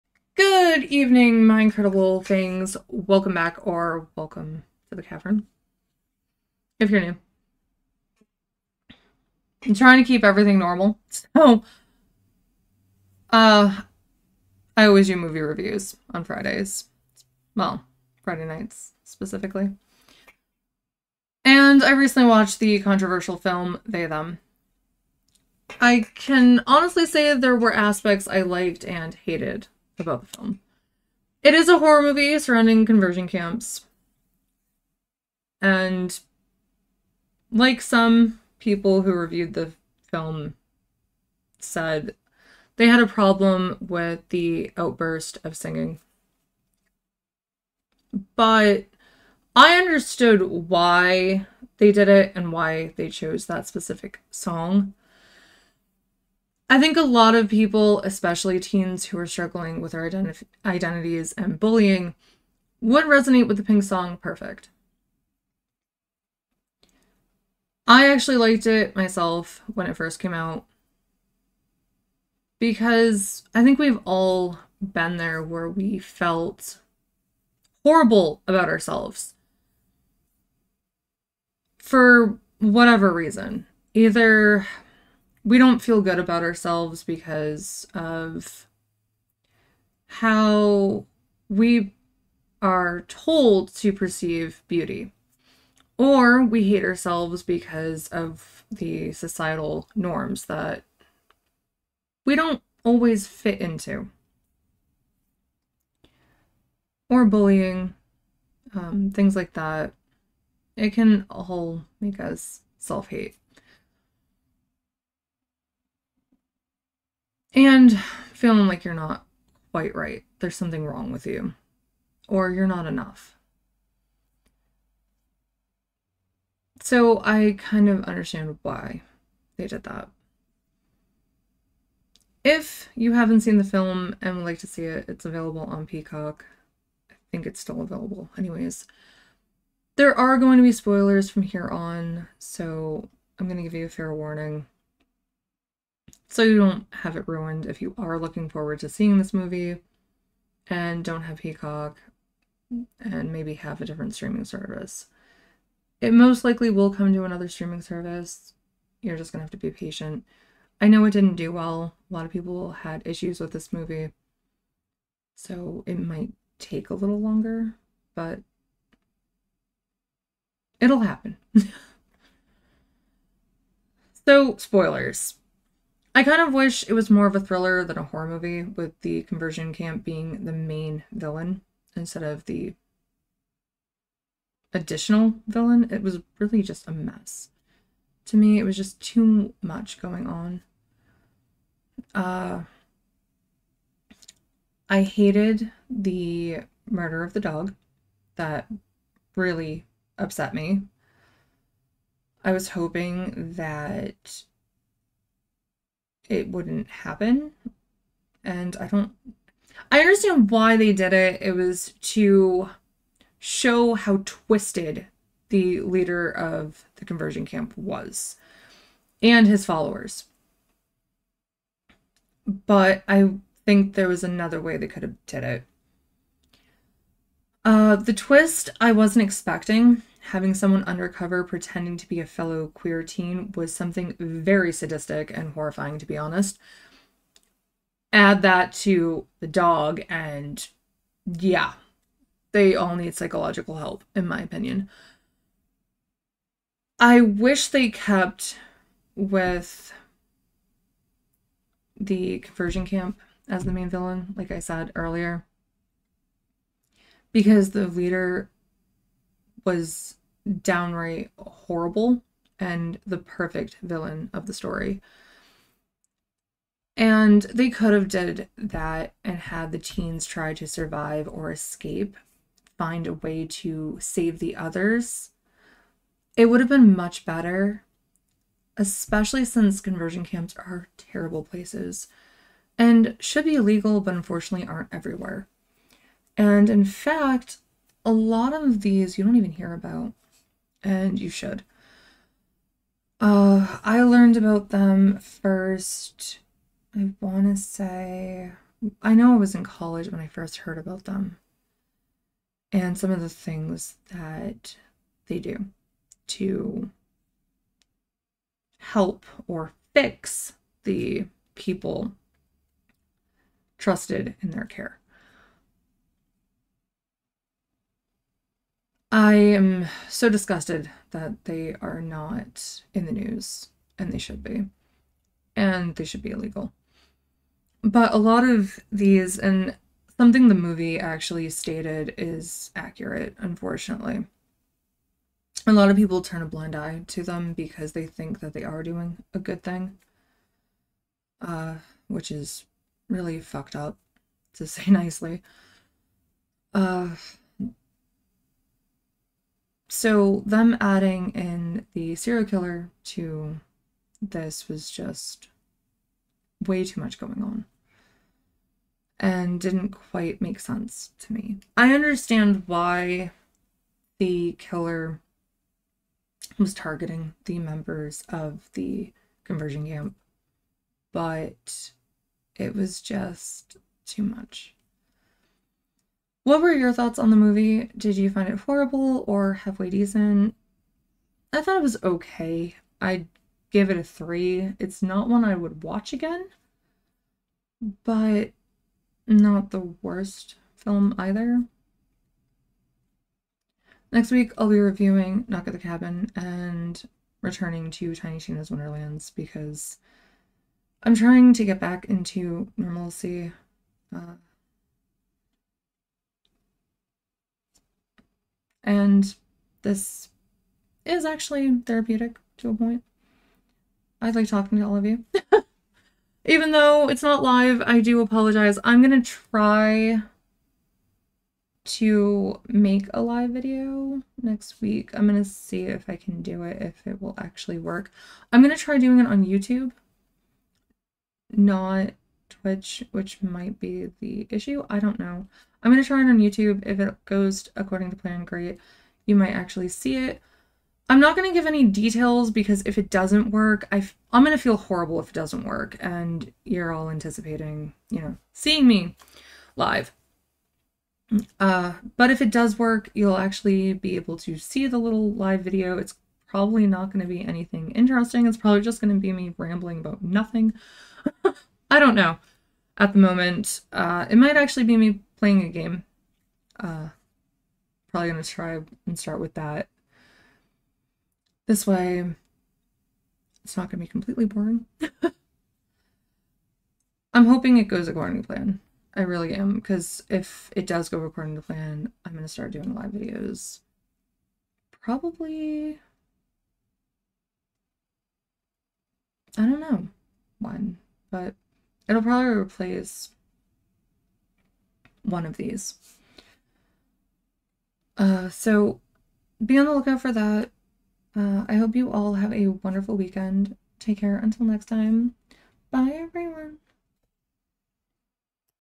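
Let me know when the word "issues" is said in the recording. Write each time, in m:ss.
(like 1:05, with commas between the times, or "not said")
2:43, 7:14.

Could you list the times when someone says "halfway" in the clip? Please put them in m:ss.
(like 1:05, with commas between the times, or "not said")
6:19.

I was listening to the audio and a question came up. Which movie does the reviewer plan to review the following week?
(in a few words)
Knock at the Cabin.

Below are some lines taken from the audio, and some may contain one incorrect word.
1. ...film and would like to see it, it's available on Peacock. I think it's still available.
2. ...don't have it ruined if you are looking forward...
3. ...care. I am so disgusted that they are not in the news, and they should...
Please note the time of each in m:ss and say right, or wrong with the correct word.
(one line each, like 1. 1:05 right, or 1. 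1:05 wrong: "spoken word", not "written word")
1. 2:13 right
2. 2:26 right
3. 5:14 right.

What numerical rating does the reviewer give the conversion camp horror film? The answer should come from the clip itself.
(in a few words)
3.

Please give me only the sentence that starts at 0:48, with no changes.
But I understood why they did it and why they chose that specific song.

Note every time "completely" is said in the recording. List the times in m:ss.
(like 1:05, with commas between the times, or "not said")
7:54.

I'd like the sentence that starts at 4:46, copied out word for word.
And in fact, a lot of these you don't even hear about, and you should.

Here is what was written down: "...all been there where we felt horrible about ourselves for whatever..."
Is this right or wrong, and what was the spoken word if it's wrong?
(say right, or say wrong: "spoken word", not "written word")
right.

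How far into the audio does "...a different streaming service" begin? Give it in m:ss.
2:33.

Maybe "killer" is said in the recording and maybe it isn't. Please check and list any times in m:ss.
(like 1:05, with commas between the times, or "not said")
5:52, 6:04.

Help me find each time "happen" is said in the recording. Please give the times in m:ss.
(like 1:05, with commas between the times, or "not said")
2:51, 3:26.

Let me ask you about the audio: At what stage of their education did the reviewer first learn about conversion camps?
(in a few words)
college.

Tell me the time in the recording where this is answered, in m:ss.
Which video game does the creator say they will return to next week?
6:38.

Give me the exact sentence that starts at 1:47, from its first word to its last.
Or bullying, um, things like that.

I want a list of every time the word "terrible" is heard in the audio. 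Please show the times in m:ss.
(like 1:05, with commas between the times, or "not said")
4:40.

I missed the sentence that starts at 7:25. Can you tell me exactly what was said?
And you're all anticipating, you know, seeing me live.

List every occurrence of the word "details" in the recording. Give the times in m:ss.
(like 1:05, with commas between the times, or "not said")
7:21.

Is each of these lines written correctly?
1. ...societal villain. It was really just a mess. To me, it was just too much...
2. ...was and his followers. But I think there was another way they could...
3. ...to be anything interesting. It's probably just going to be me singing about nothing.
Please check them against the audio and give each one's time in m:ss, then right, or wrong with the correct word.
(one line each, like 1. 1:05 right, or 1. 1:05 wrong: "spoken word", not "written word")
1. 3:04 wrong: "additional", not "societal"
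2. 3:37 right
3. 7:37 wrong: "rambling", not "singing".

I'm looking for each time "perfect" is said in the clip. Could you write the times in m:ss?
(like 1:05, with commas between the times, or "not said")
1:04, 4:23.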